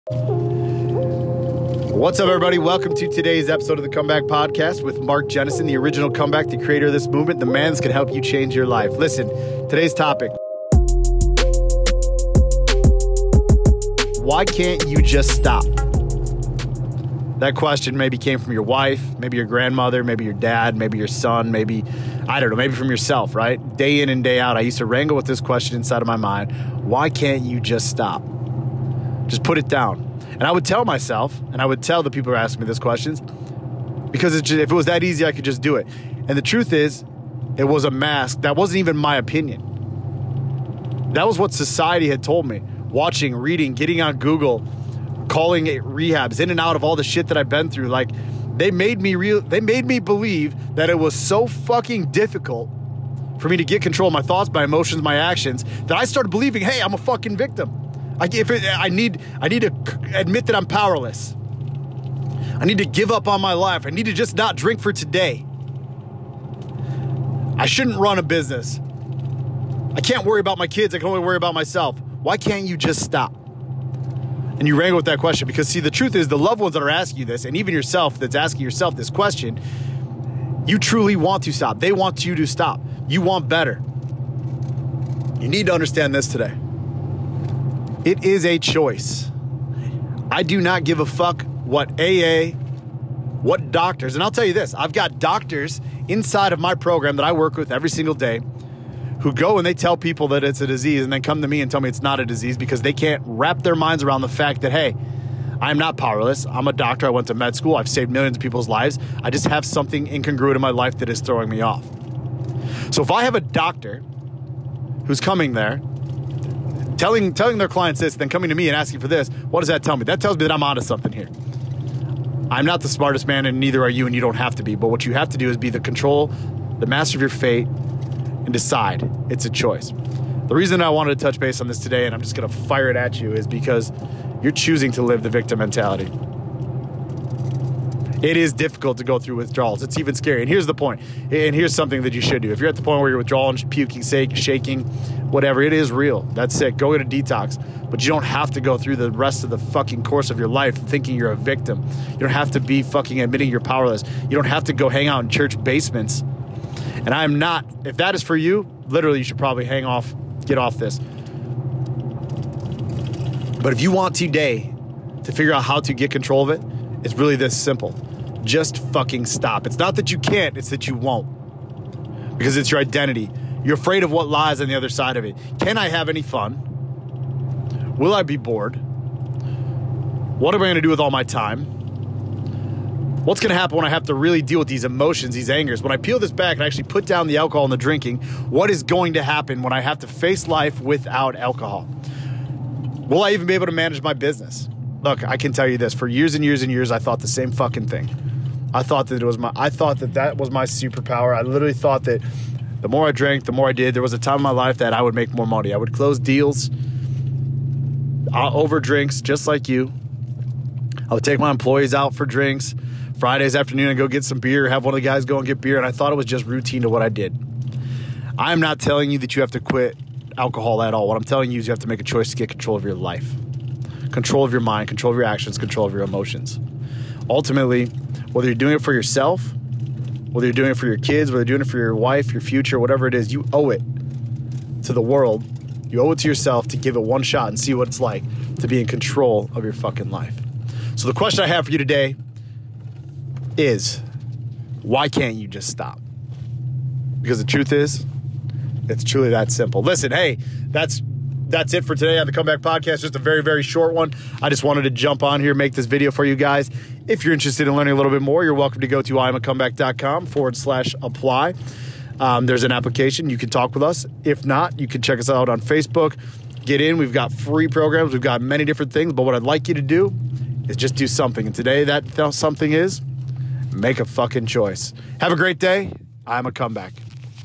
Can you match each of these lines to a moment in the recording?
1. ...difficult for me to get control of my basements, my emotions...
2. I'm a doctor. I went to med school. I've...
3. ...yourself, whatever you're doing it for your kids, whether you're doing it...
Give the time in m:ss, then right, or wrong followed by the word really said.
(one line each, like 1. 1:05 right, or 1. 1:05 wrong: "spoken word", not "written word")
1. 0:52 wrong: "thoughts", not "basements"
2. 1:46 right
3. 3:48 wrong: "whether", not "whatever".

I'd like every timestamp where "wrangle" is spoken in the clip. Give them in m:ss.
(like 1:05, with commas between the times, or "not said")
0:24, 1:14.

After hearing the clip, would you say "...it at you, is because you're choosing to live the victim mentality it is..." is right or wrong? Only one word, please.
right.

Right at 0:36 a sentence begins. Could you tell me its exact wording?
And the truth is, it was a mask.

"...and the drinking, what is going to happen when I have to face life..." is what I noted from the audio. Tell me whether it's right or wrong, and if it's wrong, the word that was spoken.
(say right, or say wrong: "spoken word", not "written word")
right.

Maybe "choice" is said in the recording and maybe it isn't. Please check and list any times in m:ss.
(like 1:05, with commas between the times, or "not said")
1:28, 2:09, 3:42, 4:34.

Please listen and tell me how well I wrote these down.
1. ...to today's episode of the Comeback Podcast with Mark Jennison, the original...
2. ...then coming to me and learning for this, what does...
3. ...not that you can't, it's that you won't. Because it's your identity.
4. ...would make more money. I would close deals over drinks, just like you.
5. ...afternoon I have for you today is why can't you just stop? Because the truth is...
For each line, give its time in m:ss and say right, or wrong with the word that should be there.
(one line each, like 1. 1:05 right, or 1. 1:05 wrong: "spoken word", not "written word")
1. 0:02 right
2. 1:58 wrong: "asking", not "learning"
3. 2:49 right
4. 3:25 right
5. 4:01 wrong: "question", not "afternoon".